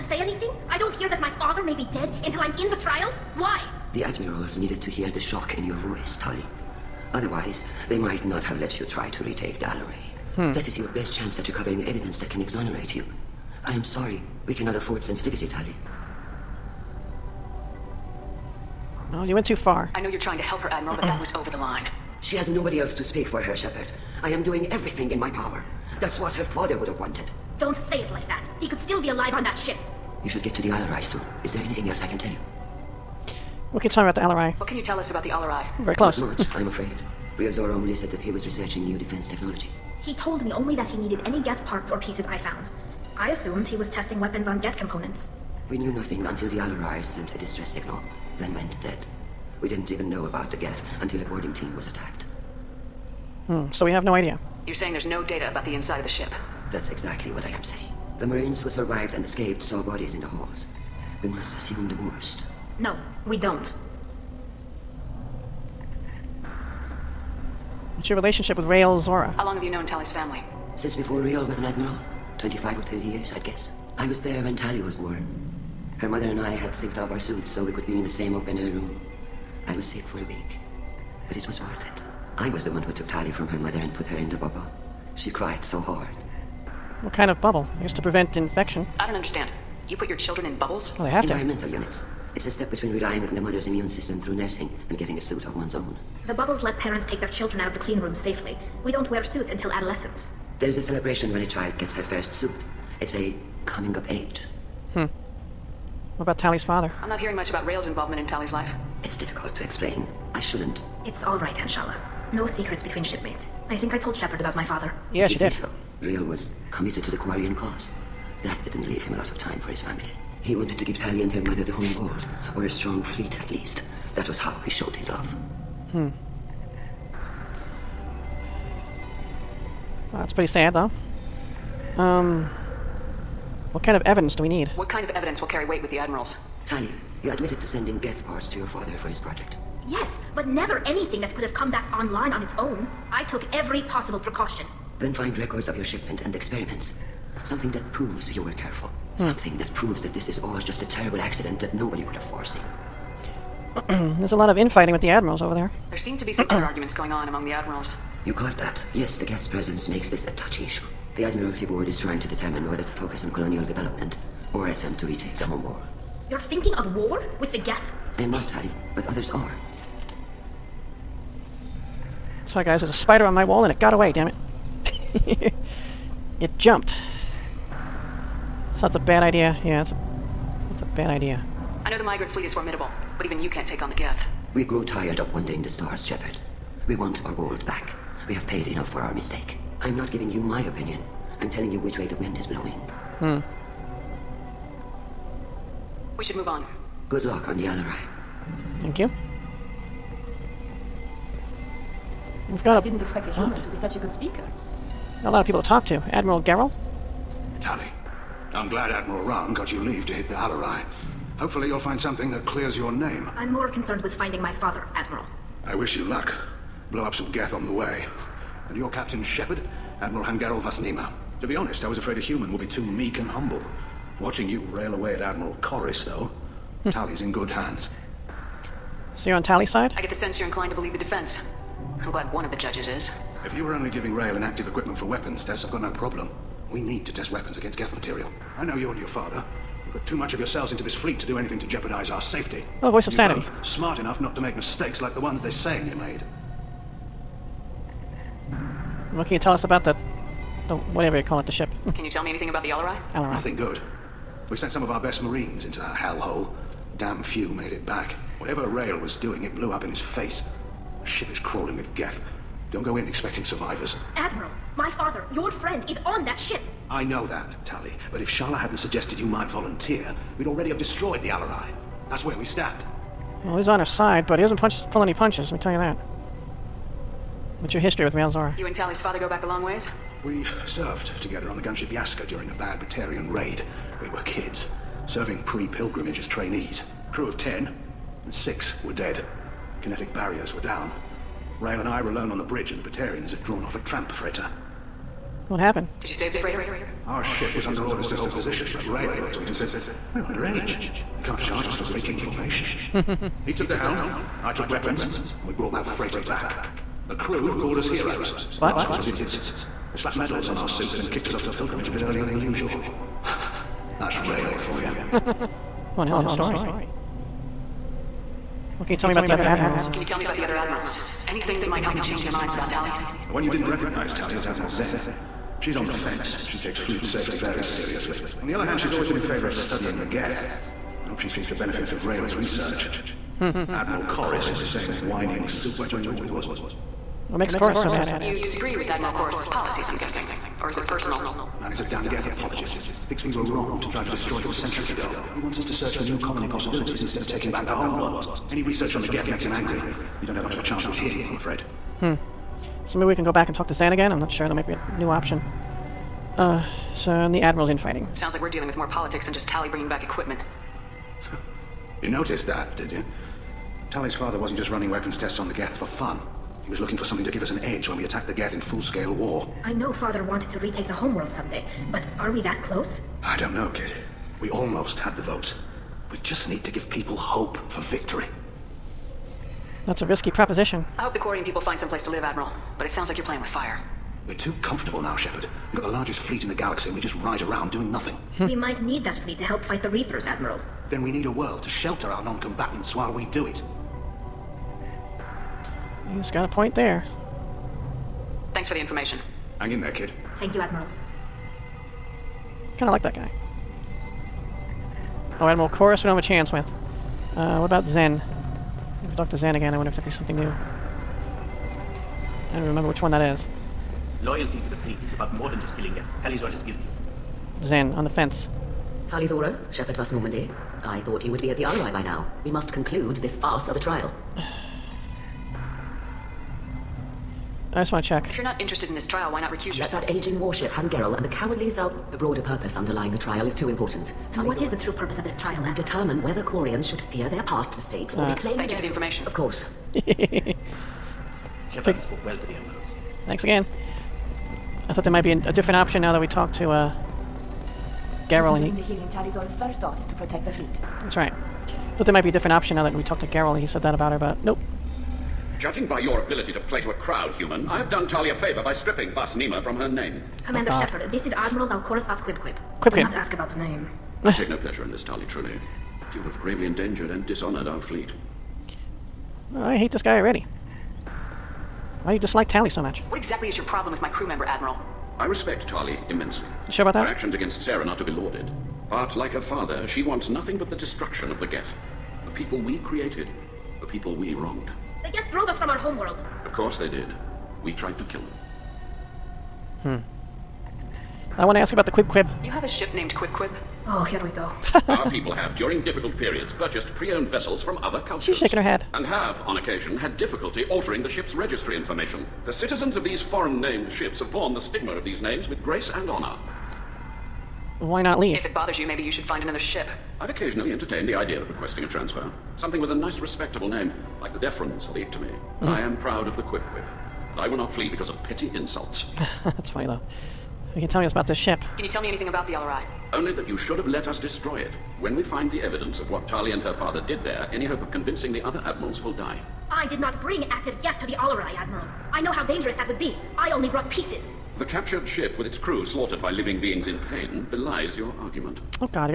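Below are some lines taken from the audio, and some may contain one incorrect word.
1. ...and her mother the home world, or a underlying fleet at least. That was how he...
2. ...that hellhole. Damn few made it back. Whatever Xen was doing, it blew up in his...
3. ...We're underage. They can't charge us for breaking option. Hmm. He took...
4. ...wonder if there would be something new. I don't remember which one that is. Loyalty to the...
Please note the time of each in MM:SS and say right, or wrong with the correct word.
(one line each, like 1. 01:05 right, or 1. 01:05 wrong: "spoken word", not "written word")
1. 02:01 wrong: "strong", not "underlying"
2. 04:15 wrong: "Rael", not "Xen"
3. 05:00 wrong: "formation", not "option"
4. 06:49 right.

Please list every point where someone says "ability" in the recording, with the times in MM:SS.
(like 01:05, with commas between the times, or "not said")
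07:36.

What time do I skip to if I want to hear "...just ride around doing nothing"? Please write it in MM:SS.
06:26.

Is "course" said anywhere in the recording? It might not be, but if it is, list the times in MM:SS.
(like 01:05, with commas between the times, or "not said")
07:19, 08:06.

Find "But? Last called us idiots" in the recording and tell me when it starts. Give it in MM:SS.
05:08.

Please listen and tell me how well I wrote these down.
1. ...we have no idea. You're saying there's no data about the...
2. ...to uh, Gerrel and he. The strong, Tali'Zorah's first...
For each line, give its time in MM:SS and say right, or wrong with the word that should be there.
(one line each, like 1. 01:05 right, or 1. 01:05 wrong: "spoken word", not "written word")
1. 00:53 right
2. 07:26 wrong: "healing", not "strong".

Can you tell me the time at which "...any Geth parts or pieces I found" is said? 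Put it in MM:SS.
00:41.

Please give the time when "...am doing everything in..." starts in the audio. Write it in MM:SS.
00:24.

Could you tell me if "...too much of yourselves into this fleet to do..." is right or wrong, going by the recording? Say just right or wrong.
right.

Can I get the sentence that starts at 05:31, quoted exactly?
I hope she sees the benefits of Rael's research.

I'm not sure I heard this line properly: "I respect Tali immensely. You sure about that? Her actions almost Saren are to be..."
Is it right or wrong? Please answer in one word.
wrong.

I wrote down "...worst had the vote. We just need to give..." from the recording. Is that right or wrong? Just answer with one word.
wrong.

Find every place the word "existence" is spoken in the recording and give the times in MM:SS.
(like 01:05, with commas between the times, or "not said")
not said.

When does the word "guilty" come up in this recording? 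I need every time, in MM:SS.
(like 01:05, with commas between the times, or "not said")
06:56.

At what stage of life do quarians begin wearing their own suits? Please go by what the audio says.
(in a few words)
Adolescence.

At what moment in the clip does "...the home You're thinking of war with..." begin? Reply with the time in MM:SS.
02:45.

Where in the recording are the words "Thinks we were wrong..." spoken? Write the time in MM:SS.
05:43.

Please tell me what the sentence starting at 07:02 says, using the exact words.
We must conclude this farce of a trial.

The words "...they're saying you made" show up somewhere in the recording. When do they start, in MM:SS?
04:05.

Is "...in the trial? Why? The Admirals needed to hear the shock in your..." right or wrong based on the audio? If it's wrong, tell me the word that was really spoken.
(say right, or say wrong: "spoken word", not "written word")
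right.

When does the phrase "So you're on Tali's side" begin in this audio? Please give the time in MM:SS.
03:49.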